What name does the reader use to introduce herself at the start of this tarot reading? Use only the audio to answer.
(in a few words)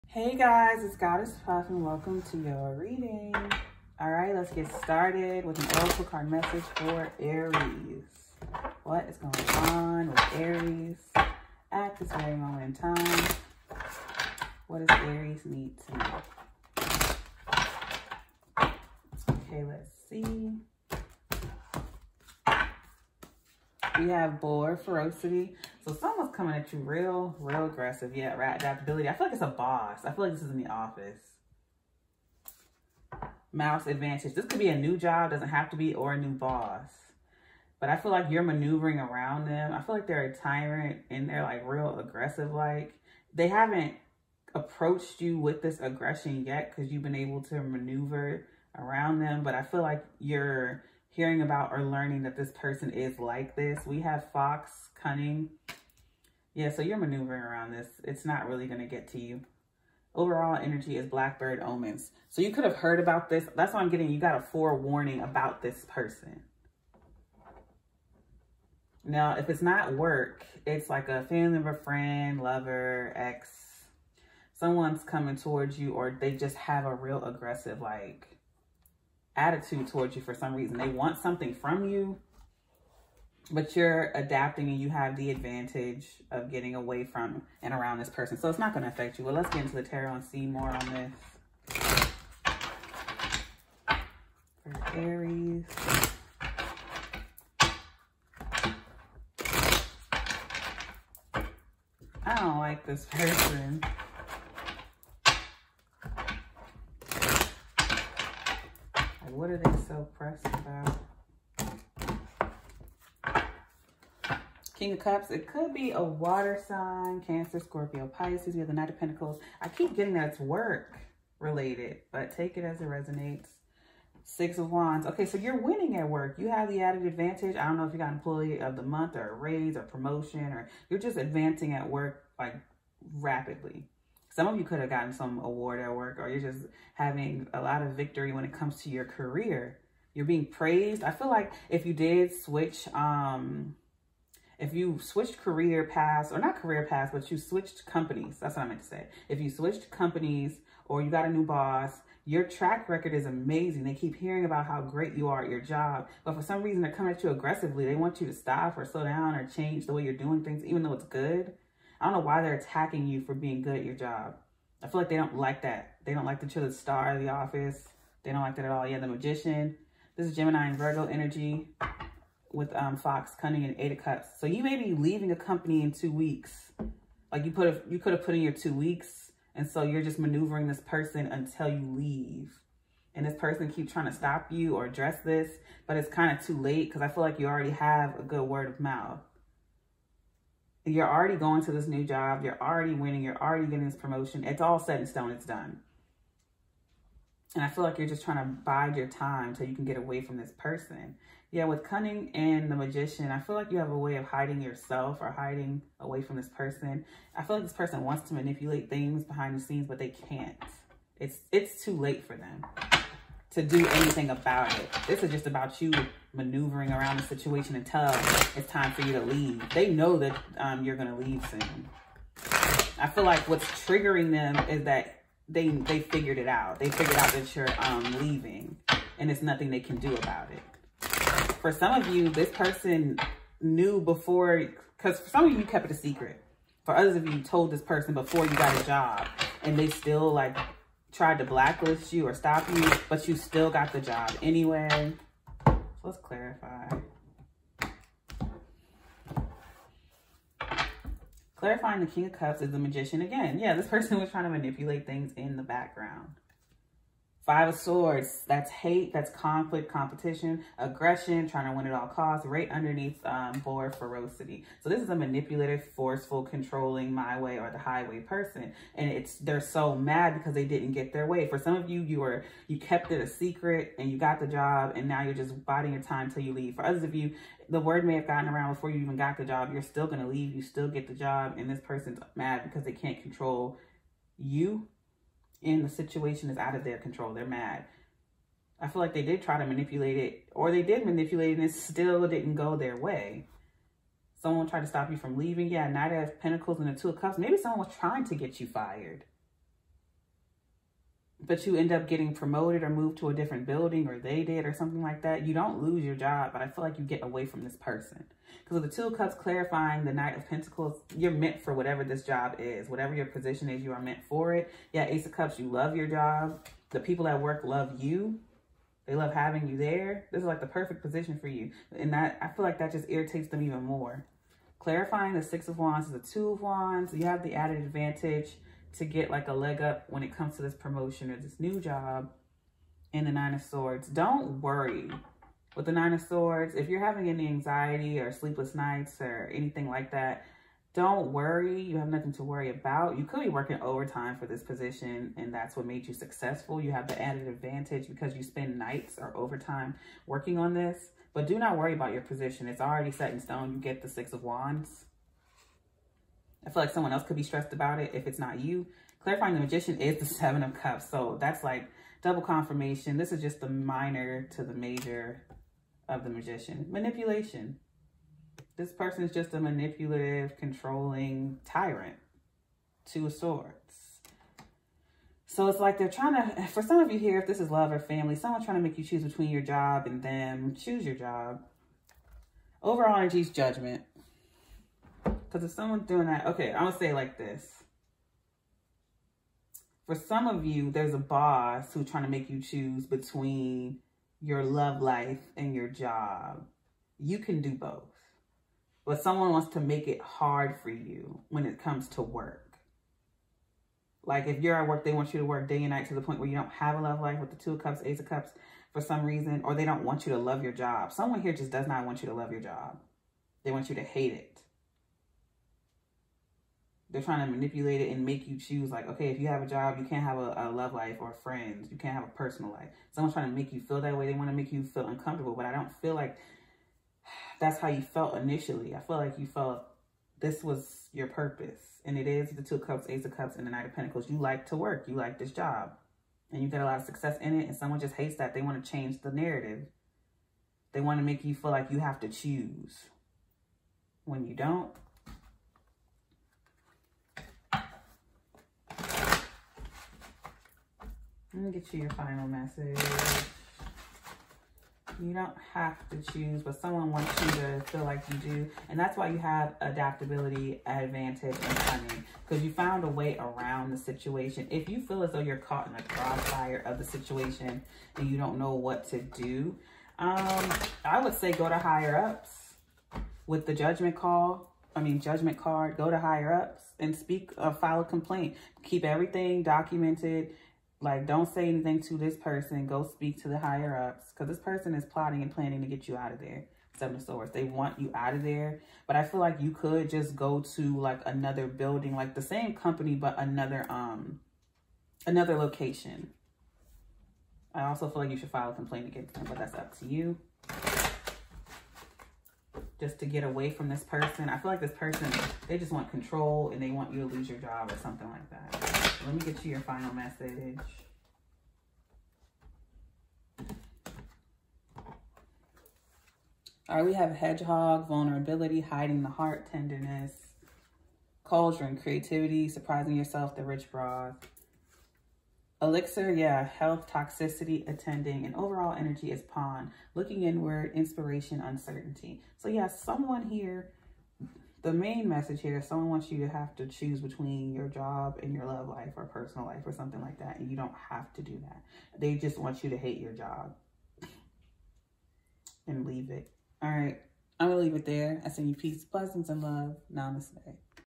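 Goddess Puff.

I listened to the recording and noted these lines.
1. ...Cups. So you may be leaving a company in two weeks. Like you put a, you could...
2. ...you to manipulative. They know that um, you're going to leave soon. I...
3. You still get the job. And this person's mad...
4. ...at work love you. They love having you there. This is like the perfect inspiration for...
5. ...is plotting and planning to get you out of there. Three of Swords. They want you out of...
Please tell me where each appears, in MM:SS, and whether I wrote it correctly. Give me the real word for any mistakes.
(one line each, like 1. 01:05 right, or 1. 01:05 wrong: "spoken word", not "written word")
1. 02:53 right
2. 03:39 wrong: "leave", not "manipulative"
3. 04:40 right
4. 05:17 wrong: "position", not "inspiration"
5. 08:04 wrong: "Seven", not "Three".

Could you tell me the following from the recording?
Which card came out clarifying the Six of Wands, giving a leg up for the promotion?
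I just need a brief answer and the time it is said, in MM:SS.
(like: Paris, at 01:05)
Two of Wands, at 05:26.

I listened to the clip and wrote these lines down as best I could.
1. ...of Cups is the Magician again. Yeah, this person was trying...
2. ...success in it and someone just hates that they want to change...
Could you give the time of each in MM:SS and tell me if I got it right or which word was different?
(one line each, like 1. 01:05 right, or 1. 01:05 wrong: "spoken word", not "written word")
1. 04:12 right
2. 07:17 right.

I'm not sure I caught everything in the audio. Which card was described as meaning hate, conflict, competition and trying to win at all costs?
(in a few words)
Five of Swords.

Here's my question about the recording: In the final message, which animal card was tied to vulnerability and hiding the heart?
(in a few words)
Hedgehog.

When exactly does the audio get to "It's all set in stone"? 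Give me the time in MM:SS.
03:14.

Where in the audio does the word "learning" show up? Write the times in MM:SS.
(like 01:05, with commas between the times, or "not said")
00:51.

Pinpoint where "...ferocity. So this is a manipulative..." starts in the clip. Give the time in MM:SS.
04:23.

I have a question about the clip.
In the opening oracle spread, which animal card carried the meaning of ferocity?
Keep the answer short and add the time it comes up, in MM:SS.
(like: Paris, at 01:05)
Boar, at 00:24.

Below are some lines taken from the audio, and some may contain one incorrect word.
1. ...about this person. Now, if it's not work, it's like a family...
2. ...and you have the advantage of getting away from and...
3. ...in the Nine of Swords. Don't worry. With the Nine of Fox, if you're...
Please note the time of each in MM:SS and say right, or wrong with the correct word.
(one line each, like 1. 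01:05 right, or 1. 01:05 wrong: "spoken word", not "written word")
1. 01:05 right
2. 01:24 right
3. 05:33 wrong: "Swords", not "Fox".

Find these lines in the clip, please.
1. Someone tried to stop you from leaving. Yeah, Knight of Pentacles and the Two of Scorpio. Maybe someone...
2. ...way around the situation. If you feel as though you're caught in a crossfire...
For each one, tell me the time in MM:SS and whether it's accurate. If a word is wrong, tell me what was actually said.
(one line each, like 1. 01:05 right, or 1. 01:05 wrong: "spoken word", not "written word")
1. 04:54 wrong: "Cups", not "Scorpio"
2. 07:43 right.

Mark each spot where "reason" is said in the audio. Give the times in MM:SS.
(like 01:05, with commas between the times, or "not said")
01:20, 02:36, 06:49.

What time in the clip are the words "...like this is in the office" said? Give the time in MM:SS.
00:30.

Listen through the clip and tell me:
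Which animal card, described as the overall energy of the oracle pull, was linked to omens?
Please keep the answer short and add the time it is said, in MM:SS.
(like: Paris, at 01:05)
Blackbird, at 01:01.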